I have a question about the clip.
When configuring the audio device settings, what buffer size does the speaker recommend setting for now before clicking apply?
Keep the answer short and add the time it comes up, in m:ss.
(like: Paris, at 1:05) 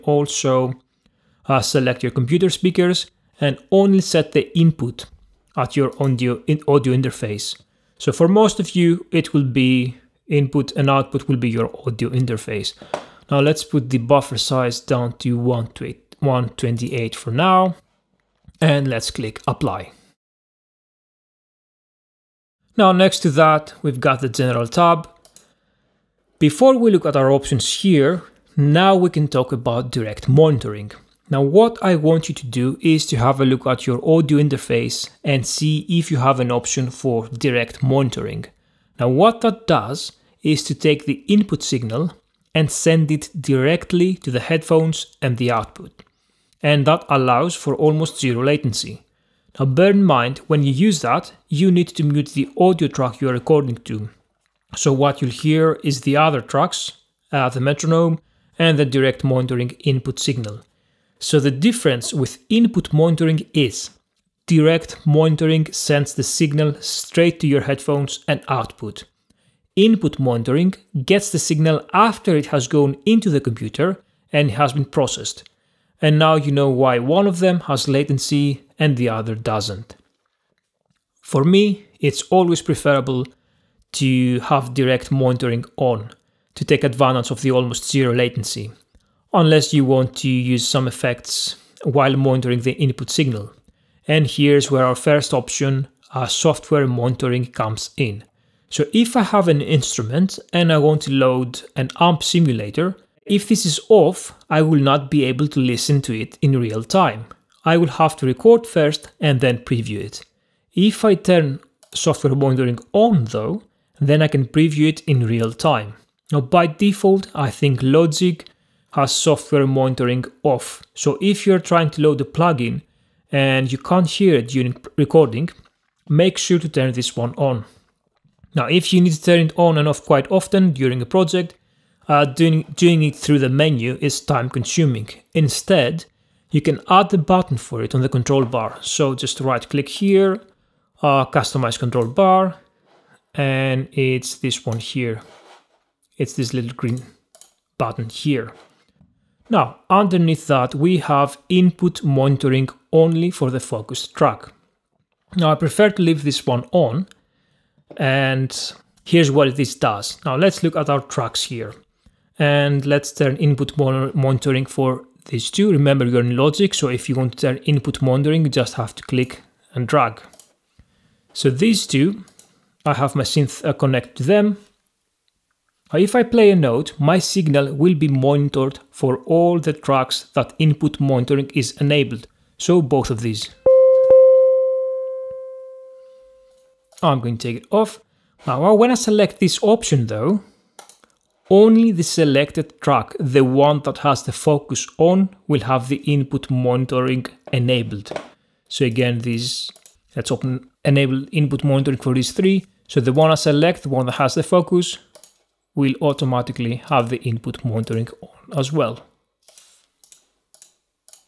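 128, at 0:15.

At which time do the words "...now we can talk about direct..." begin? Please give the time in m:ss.
0:28.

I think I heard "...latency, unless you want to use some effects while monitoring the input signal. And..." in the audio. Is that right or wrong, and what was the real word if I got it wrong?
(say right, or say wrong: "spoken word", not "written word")
right.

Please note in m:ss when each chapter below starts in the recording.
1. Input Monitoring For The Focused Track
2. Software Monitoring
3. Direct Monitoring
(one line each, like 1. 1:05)
1. 2:30
2. 1:34
3. 0:28.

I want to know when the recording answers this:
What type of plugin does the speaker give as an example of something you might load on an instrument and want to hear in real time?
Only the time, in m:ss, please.
1:41.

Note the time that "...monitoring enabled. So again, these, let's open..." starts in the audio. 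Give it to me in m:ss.
3:16.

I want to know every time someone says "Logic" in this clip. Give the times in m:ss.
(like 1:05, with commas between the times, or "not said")
1:57, 2:46.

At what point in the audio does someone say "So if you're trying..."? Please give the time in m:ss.
2:00.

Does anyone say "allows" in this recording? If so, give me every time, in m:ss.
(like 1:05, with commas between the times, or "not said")
0:47.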